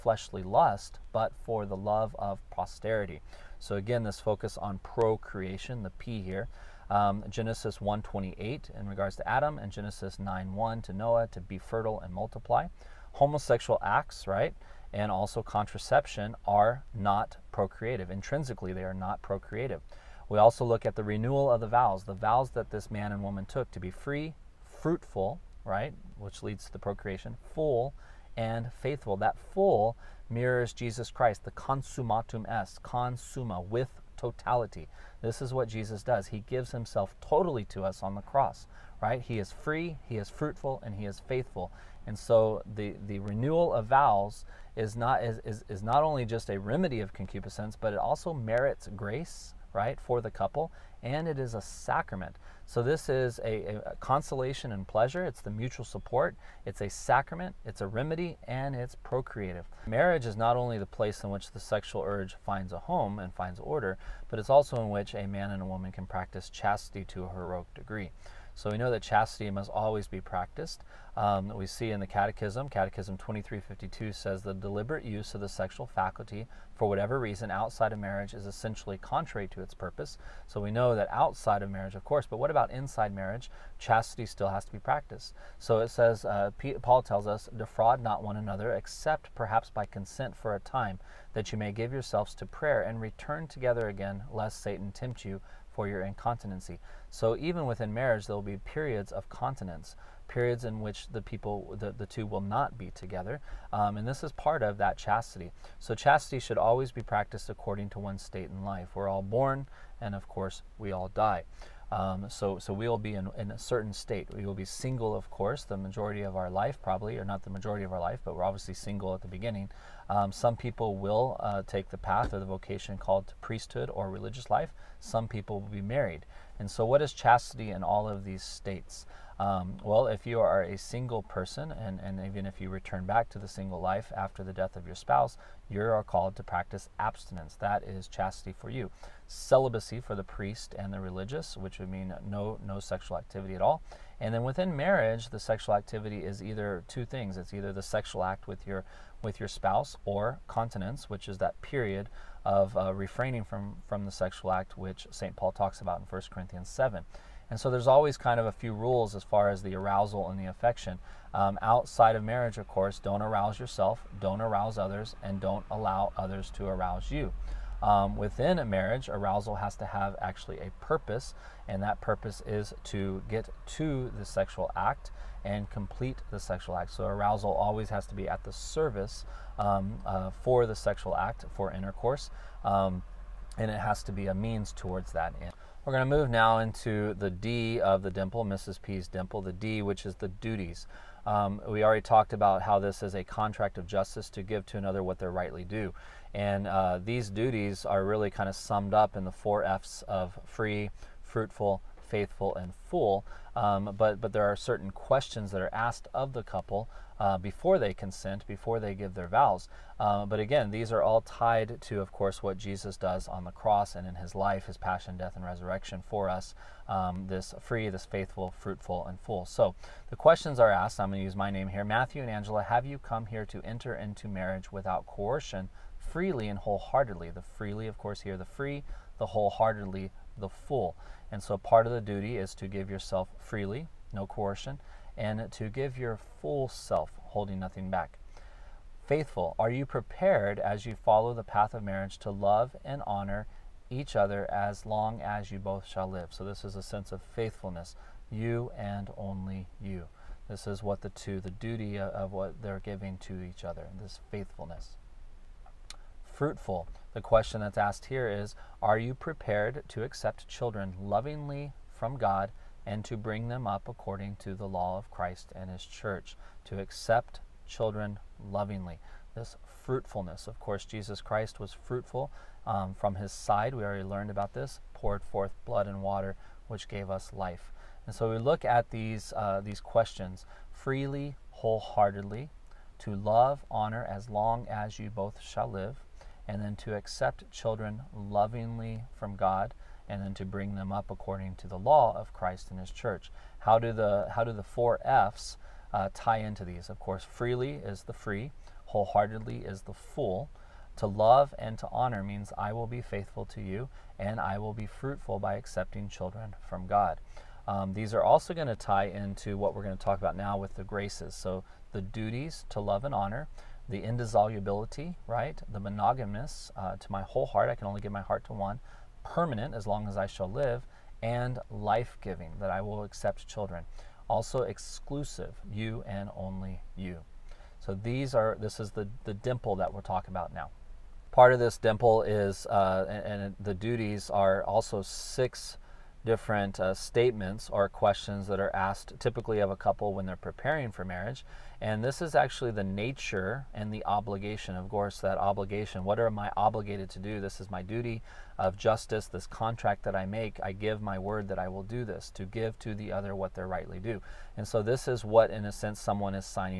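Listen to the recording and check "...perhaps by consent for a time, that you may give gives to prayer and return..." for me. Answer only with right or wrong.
wrong.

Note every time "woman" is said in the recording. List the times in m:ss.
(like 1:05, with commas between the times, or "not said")
0:23, 1:05.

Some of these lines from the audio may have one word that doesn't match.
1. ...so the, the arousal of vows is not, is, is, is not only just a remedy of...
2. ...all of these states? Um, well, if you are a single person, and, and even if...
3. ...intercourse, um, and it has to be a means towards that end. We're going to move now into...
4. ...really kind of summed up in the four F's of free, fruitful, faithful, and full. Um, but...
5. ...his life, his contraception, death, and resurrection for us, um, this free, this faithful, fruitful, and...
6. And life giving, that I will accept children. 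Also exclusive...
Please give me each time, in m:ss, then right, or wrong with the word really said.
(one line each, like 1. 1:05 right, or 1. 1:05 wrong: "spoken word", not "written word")
1. 0:42 wrong: "renewal", not "arousal"
2. 2:07 right
3. 3:01 right
4. 3:18 right
5. 3:34 wrong: "passion", not "contraception"
6. 5:21 right.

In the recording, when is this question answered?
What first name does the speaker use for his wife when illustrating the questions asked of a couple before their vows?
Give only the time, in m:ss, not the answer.
3:42.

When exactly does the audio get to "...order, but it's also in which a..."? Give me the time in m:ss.
1:03.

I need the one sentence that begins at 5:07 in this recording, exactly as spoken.
Um, these are also going to tie into what we're going to talk about now with the graces.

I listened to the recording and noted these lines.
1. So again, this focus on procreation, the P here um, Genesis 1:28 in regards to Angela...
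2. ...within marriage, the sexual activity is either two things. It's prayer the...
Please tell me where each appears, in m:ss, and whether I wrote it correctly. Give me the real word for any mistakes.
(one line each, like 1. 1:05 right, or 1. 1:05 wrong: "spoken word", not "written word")
1. 0:03 wrong: "Adam", not "Angela"
2. 2:24 wrong: "either", not "prayer".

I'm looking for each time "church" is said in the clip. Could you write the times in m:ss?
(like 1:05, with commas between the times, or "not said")
4:25, 4:52.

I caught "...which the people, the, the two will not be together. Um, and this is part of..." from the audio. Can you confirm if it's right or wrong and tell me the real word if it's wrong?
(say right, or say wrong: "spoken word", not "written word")
right.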